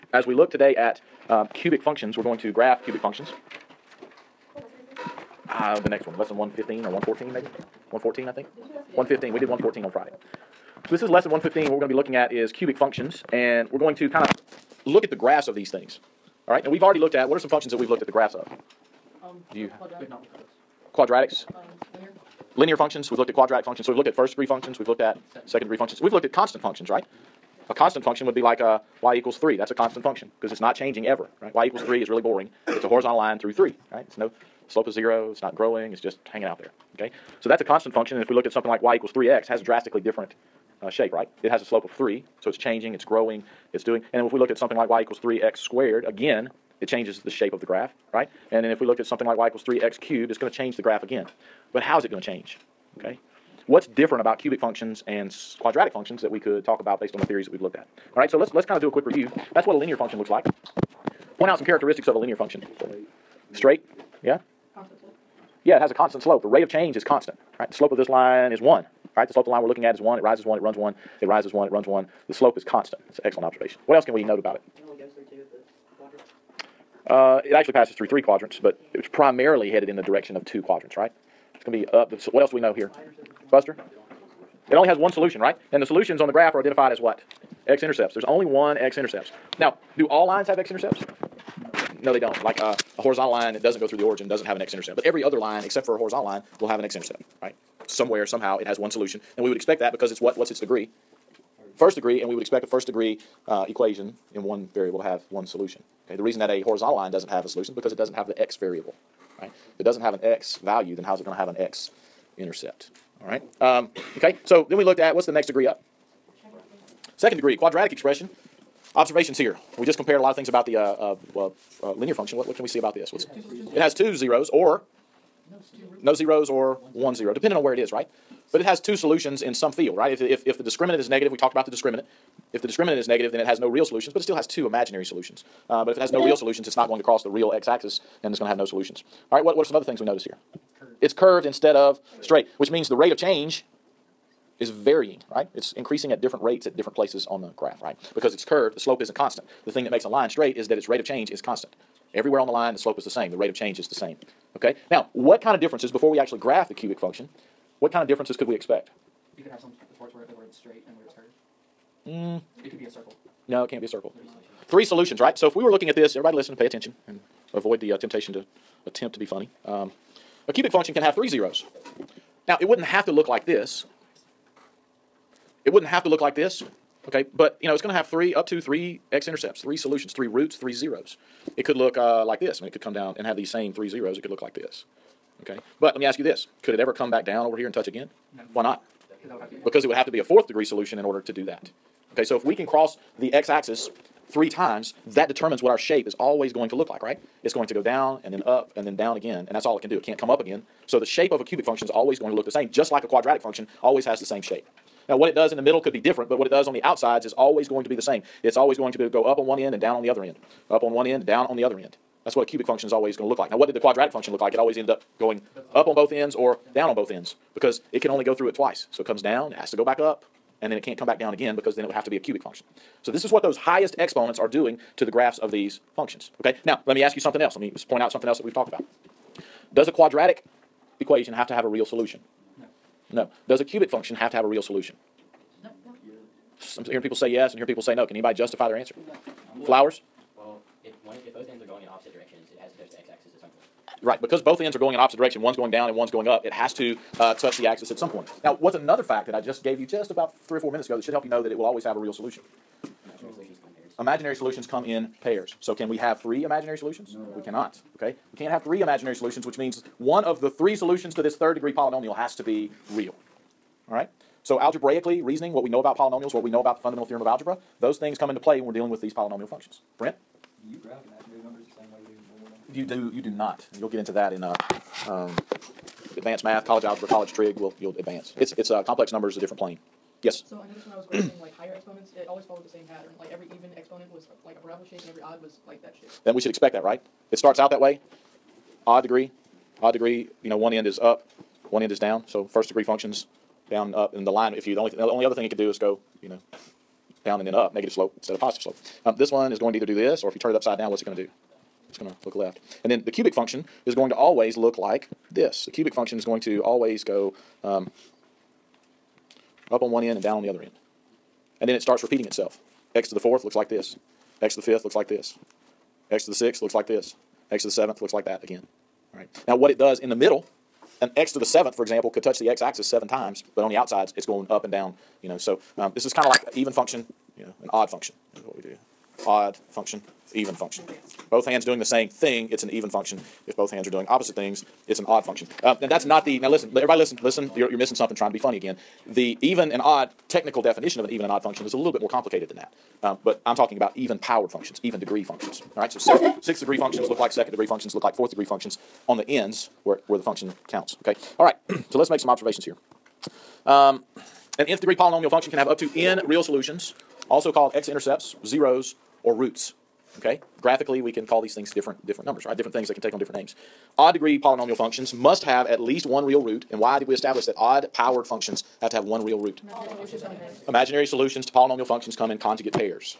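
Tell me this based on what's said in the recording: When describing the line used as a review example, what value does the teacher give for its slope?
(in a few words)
1.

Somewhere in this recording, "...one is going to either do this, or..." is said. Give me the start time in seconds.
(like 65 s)
299 s.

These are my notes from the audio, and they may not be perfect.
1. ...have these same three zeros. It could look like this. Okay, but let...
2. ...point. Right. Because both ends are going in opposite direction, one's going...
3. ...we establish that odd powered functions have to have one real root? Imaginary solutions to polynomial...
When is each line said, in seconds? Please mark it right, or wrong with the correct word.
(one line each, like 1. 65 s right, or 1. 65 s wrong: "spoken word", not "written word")
1. 183 s right
2. 243 s right
3. 367 s right.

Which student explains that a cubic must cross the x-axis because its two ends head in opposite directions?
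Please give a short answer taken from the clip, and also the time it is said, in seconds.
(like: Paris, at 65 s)
Flowers, at 239 s.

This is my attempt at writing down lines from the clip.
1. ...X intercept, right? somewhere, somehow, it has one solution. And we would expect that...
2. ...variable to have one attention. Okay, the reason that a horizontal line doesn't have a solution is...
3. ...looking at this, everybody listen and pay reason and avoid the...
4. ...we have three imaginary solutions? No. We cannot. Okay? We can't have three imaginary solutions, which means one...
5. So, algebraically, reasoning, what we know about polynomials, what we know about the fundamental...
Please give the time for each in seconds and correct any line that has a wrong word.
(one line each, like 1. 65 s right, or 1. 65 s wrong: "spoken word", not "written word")
1. 96 s right
2. 104 s wrong: "solution", not "attention"
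3. 165 s wrong: "attention", not "reason"
4. 255 s right
5. 264 s right.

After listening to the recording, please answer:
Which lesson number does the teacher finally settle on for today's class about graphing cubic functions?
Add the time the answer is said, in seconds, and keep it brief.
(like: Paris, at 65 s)
115, at 10 s.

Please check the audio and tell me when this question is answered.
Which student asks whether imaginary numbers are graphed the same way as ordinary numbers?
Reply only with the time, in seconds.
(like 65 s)
269 s.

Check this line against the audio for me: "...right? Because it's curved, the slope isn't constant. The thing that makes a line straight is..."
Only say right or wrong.
right.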